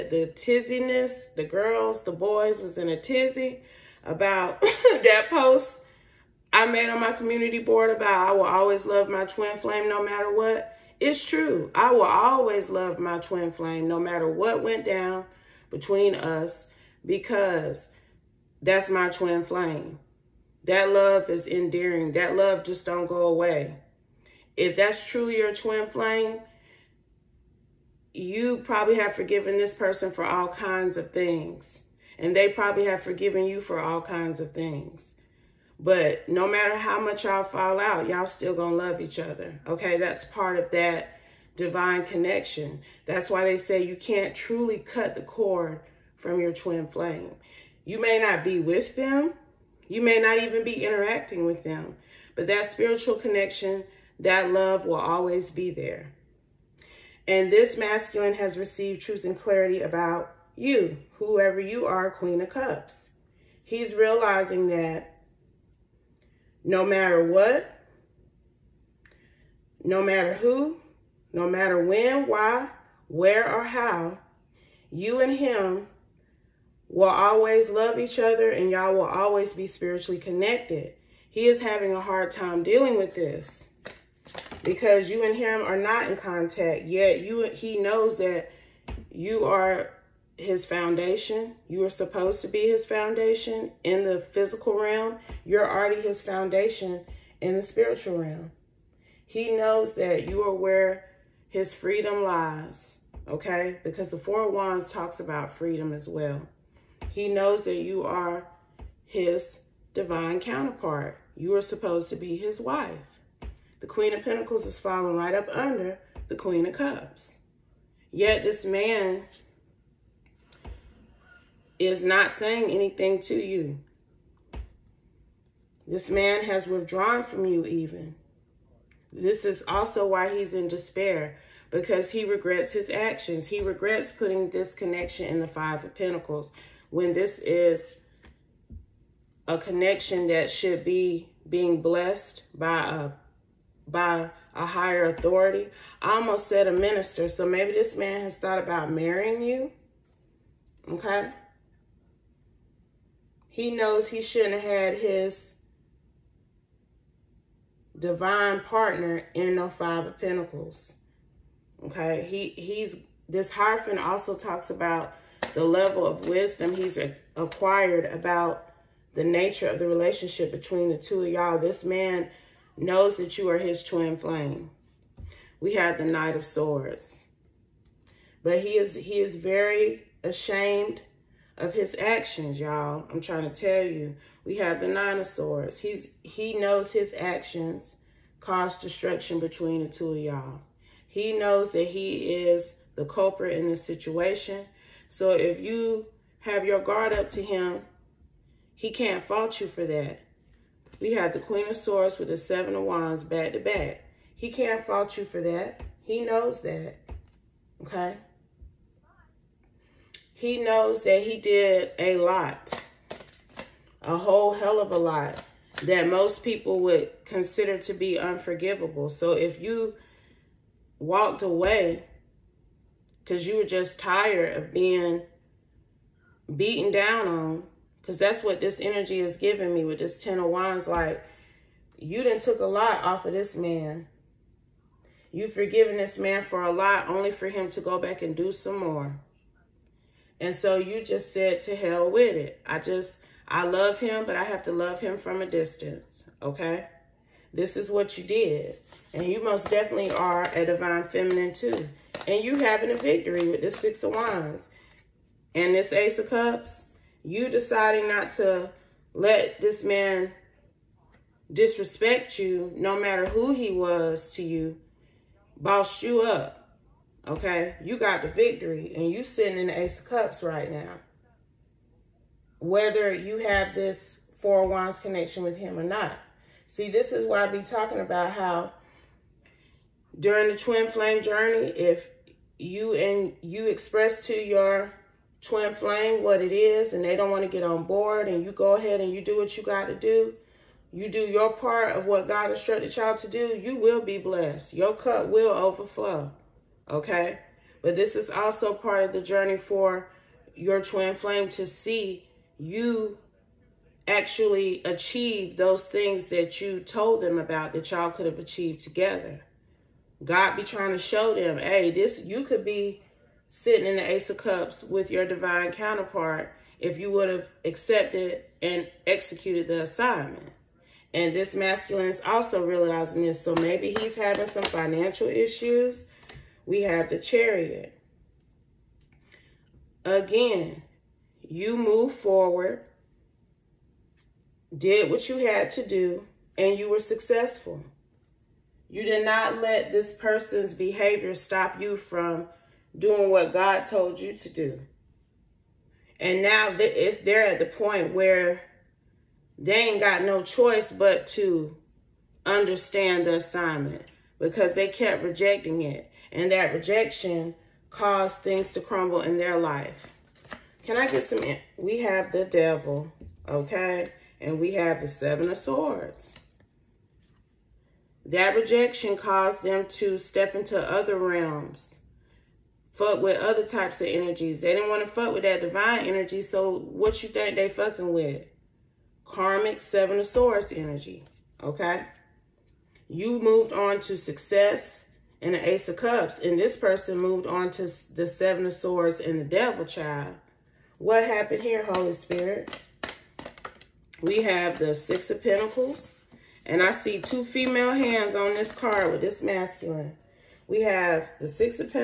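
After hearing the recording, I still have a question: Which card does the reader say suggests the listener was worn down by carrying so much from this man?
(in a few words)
10 of Wands.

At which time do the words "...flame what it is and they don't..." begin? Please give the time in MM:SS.
04:45.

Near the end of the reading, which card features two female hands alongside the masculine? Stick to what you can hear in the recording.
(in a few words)
Six of Pentacles.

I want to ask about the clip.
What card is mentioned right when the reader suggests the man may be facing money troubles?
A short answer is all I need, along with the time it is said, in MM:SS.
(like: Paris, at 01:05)
The Chariot, at 05:27.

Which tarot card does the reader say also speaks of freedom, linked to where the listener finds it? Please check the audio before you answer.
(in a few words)
Four of Wands.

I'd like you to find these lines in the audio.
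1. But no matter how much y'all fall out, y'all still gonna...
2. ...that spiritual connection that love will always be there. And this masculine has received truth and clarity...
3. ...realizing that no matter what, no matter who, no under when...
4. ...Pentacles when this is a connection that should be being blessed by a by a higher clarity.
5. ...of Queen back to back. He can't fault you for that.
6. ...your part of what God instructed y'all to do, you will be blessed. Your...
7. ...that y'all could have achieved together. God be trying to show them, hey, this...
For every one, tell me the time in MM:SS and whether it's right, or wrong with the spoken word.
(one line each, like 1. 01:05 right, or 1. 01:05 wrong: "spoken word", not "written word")
1. 00:35 right
2. 00:52 right
3. 01:03 wrong: "matter", not "under"
4. 02:15 wrong: "authority", not "clarity"
5. 03:22 wrong: "Wands", not "Queen"
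6. 04:51 right
7. 05:07 right.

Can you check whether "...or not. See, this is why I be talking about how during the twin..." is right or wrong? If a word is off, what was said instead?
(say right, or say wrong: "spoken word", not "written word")
right.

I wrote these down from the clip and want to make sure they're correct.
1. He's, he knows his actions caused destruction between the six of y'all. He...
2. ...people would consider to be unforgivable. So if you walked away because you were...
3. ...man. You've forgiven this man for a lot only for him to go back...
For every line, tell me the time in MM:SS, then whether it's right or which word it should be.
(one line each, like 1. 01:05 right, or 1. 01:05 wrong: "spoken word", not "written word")
1. 03:05 wrong: "two", not "six"
2. 03:36 right
3. 03:53 right.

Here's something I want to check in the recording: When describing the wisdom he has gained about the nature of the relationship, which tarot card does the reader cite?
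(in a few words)
Hierophant.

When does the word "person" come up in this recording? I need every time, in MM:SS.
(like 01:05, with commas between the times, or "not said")
00:29, 05:40, 06:26.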